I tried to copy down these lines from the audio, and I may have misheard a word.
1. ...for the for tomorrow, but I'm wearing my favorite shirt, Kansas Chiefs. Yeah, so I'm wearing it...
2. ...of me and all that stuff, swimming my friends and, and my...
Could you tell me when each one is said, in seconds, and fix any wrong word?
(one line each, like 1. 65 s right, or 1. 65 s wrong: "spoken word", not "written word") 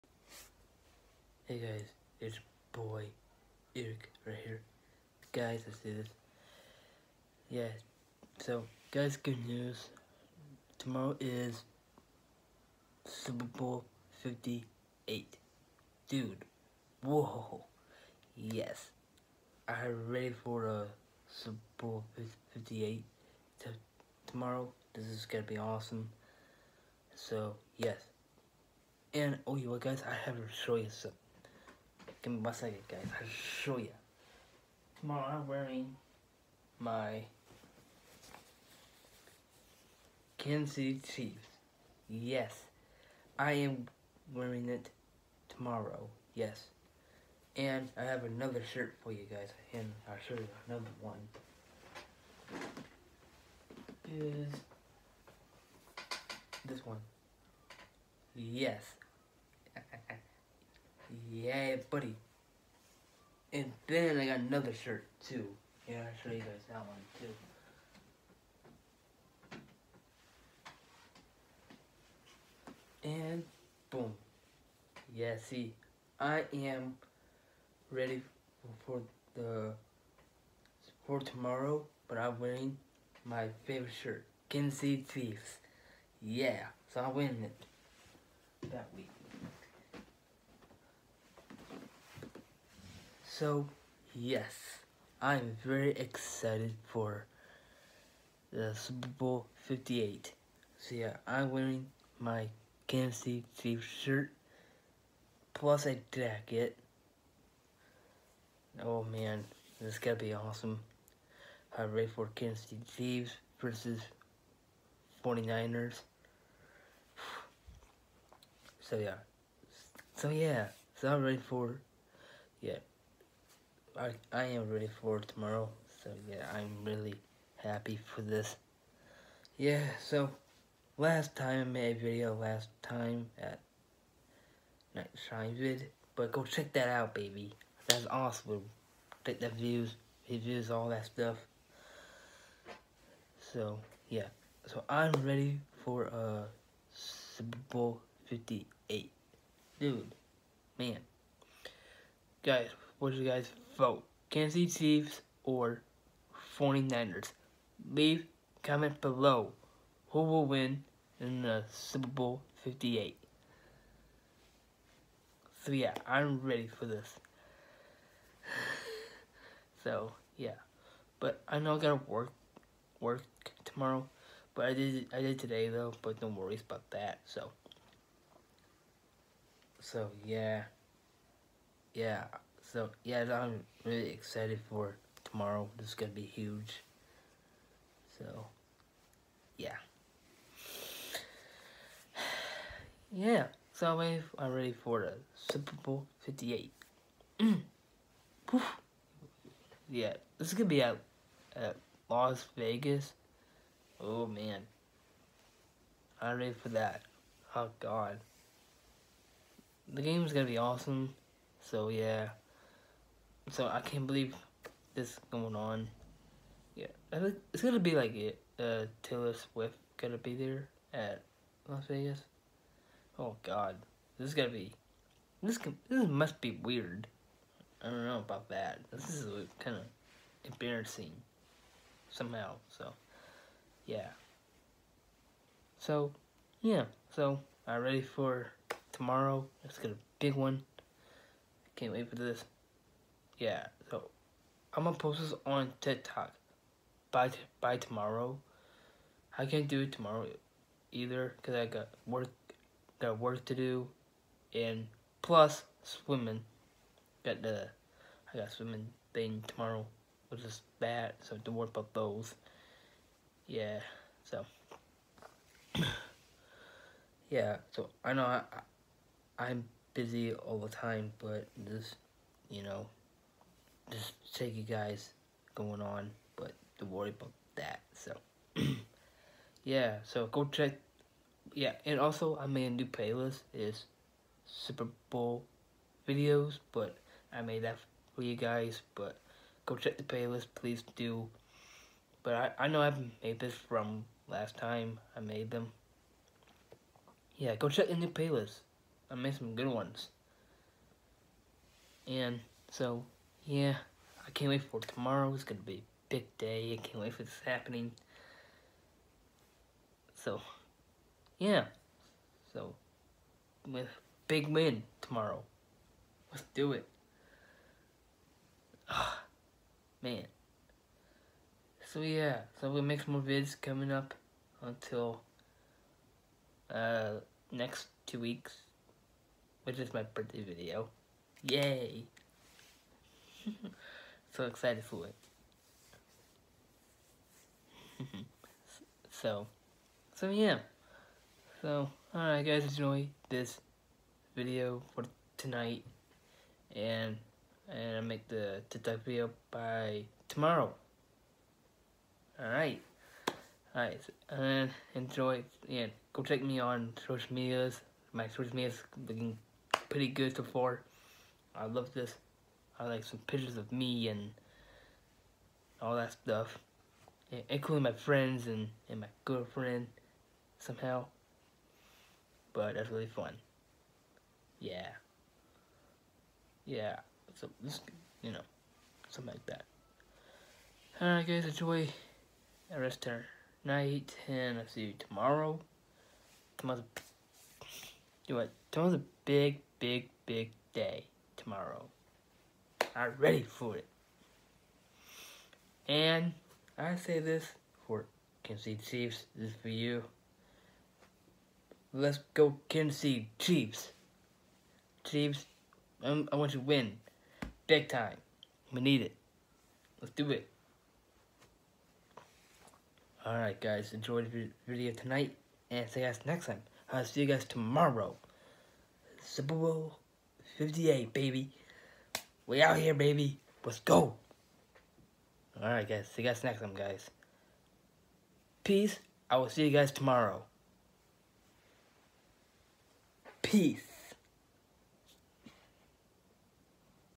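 1. 78 s right
2. 363 s wrong: "including", not "swimming".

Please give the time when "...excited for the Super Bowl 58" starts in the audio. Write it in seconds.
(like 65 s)
95 s.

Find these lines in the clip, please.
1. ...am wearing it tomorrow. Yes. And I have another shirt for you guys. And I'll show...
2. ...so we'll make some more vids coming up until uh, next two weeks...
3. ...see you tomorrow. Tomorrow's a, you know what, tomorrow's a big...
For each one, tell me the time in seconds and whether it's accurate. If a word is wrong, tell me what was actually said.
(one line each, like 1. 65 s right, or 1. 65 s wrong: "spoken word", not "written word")
1. 43 s right
2. 322 s right
3. 384 s right.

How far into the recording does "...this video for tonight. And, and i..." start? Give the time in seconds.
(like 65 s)
343 s.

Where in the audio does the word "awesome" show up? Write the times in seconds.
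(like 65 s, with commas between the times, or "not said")
25 s, 110 s, 138 s, 210 s.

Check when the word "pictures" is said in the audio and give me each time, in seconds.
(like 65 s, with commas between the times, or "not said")
363 s.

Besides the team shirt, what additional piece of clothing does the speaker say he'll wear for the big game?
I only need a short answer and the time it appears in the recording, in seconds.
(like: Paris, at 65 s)
jacket, at 105 s.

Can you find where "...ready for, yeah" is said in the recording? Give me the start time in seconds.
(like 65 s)
121 s.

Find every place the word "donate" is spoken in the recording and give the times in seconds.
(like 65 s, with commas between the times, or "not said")
not said.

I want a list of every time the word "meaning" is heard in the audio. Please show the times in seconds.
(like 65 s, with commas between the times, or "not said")
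not said.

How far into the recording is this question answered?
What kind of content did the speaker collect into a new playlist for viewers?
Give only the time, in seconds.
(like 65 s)
284 s.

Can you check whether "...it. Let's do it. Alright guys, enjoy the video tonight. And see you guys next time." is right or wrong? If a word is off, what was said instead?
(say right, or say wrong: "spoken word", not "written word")
right.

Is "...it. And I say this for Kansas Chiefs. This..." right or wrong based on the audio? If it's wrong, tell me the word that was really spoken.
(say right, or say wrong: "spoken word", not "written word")
right.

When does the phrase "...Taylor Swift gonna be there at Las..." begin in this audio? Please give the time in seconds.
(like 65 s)
219 s.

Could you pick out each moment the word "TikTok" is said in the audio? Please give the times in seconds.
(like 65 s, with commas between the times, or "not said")
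245 s, 348 s.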